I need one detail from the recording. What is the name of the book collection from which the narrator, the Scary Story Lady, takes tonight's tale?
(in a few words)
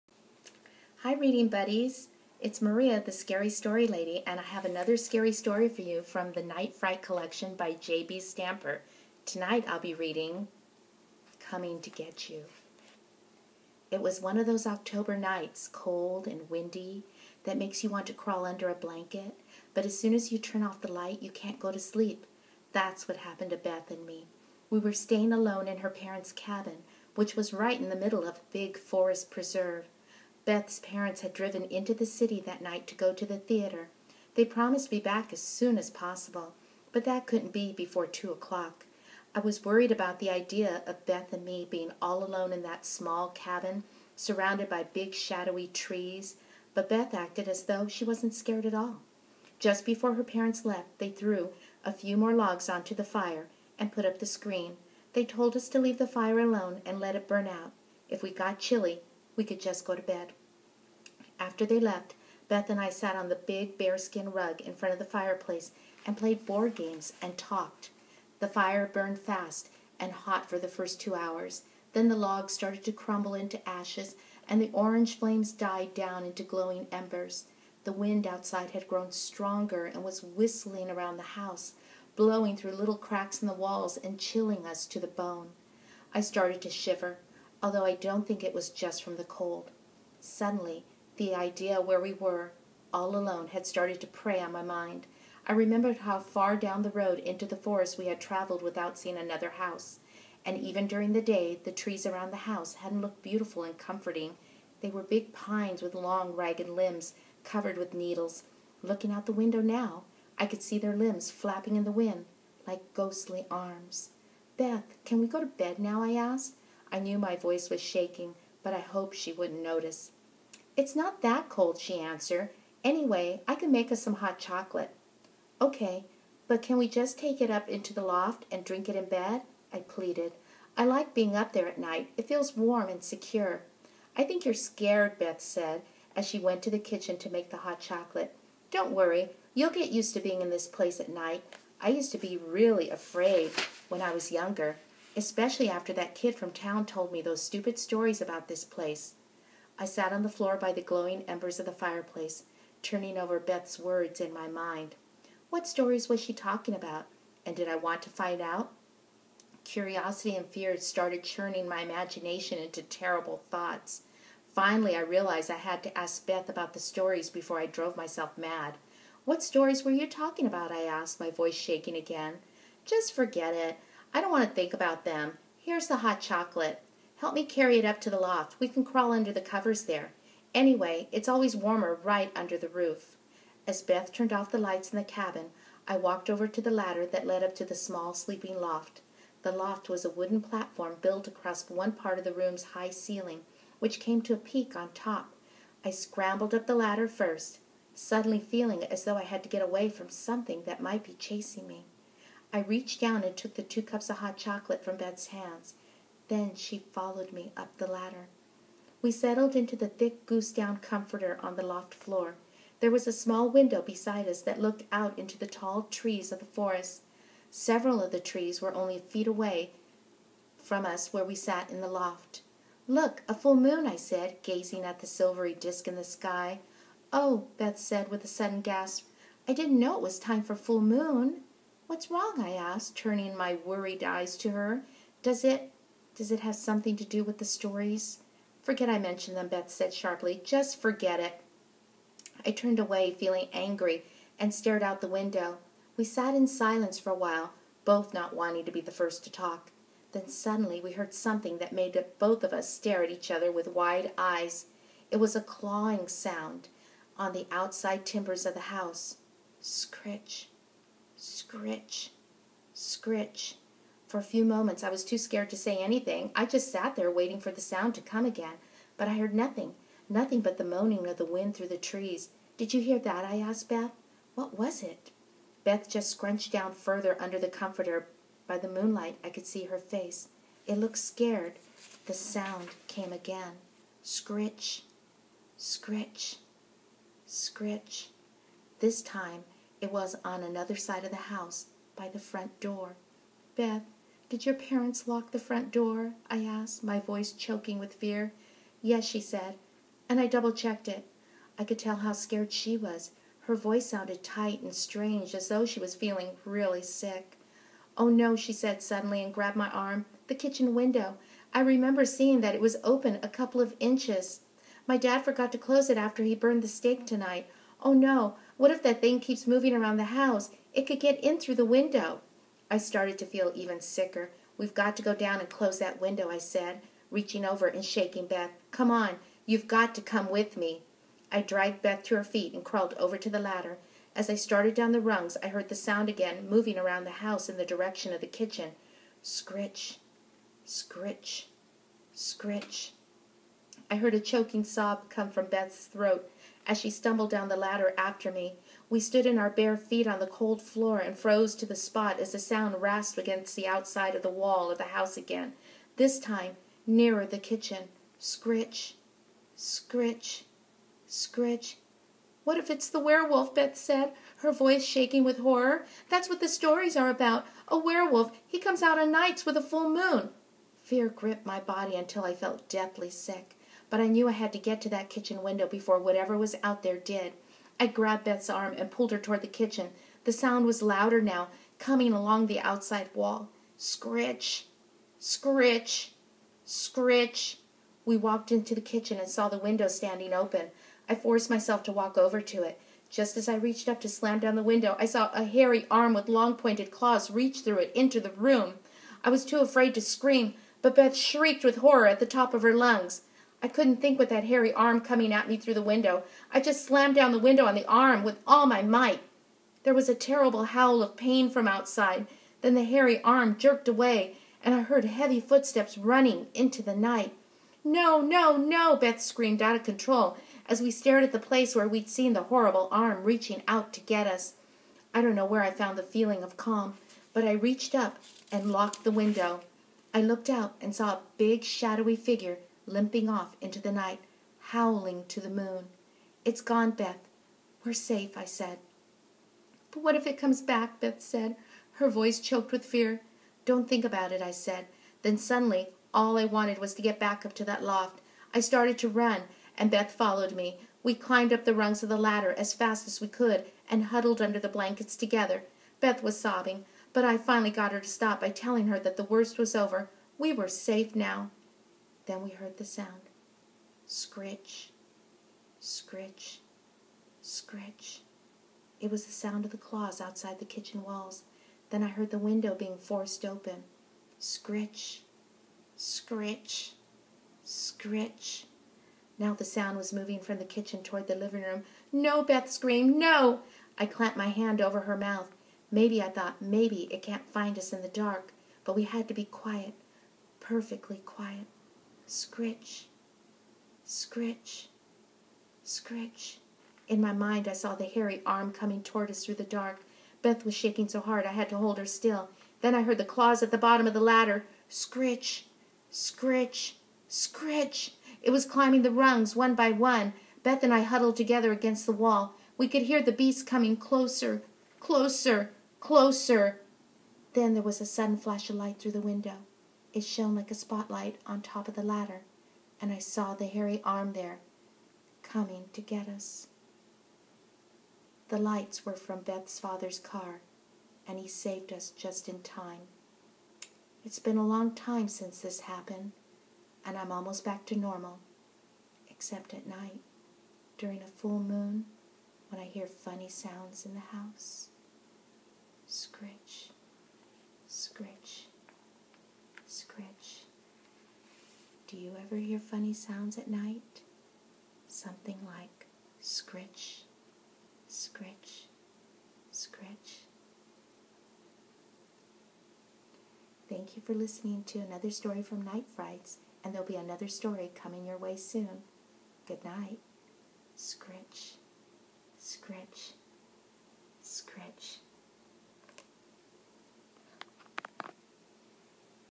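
Night Fright Collection.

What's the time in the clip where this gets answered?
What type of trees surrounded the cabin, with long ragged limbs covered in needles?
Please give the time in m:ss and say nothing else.
1:45.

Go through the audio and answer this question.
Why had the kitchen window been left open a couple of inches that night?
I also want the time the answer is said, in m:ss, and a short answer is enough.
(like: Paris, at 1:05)
burned the steak, at 5:16.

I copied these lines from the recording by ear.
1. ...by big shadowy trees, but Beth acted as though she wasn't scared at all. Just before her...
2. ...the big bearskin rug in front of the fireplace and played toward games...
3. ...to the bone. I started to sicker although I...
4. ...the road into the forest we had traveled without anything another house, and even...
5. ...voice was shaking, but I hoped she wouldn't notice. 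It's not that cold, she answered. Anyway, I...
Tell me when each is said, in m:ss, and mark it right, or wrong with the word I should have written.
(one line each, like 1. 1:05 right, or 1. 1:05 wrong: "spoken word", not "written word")
1. 0:44 right
2. 1:03 wrong: "board", not "toward"
3. 1:24 wrong: "shiver", not "sicker"
4. 1:36 wrong: "seeing", not "anything"
5. 1:57 right.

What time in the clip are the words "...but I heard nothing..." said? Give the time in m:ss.
4:28.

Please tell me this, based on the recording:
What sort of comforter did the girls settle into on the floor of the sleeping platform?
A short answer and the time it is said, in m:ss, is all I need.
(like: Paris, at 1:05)
goose down, at 3:30.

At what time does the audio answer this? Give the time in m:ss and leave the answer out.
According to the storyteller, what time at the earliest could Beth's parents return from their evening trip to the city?
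0:38.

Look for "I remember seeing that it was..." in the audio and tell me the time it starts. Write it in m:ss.
5:11.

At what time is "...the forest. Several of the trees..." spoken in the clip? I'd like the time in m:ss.
3:36.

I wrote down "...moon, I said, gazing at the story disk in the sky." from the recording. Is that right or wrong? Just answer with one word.
wrong.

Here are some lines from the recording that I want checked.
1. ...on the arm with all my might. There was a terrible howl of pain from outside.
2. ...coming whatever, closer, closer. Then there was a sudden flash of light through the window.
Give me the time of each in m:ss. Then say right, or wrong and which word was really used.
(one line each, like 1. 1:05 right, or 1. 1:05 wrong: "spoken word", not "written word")
1. 6:47 right
2. 8:33 wrong: "closer", not "whatever".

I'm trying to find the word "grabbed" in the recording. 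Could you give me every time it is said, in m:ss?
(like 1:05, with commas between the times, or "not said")
5:09, 6:17.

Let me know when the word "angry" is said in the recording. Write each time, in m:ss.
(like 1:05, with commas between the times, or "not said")
4:03.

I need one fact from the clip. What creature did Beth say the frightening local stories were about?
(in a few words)
a werewolf.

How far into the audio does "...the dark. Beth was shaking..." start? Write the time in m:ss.
8:19.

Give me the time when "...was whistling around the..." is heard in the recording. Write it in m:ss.
1:20.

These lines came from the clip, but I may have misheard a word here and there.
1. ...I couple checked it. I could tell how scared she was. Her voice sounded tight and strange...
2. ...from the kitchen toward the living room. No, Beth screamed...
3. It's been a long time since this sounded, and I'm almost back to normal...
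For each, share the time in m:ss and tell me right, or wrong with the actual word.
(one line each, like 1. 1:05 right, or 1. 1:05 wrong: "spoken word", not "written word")
1. 5:00 wrong: "double", not "couple"
2. 8:00 right
3. 8:54 wrong: "happened", not "sounded".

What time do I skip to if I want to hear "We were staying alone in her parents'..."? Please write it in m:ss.
0:24.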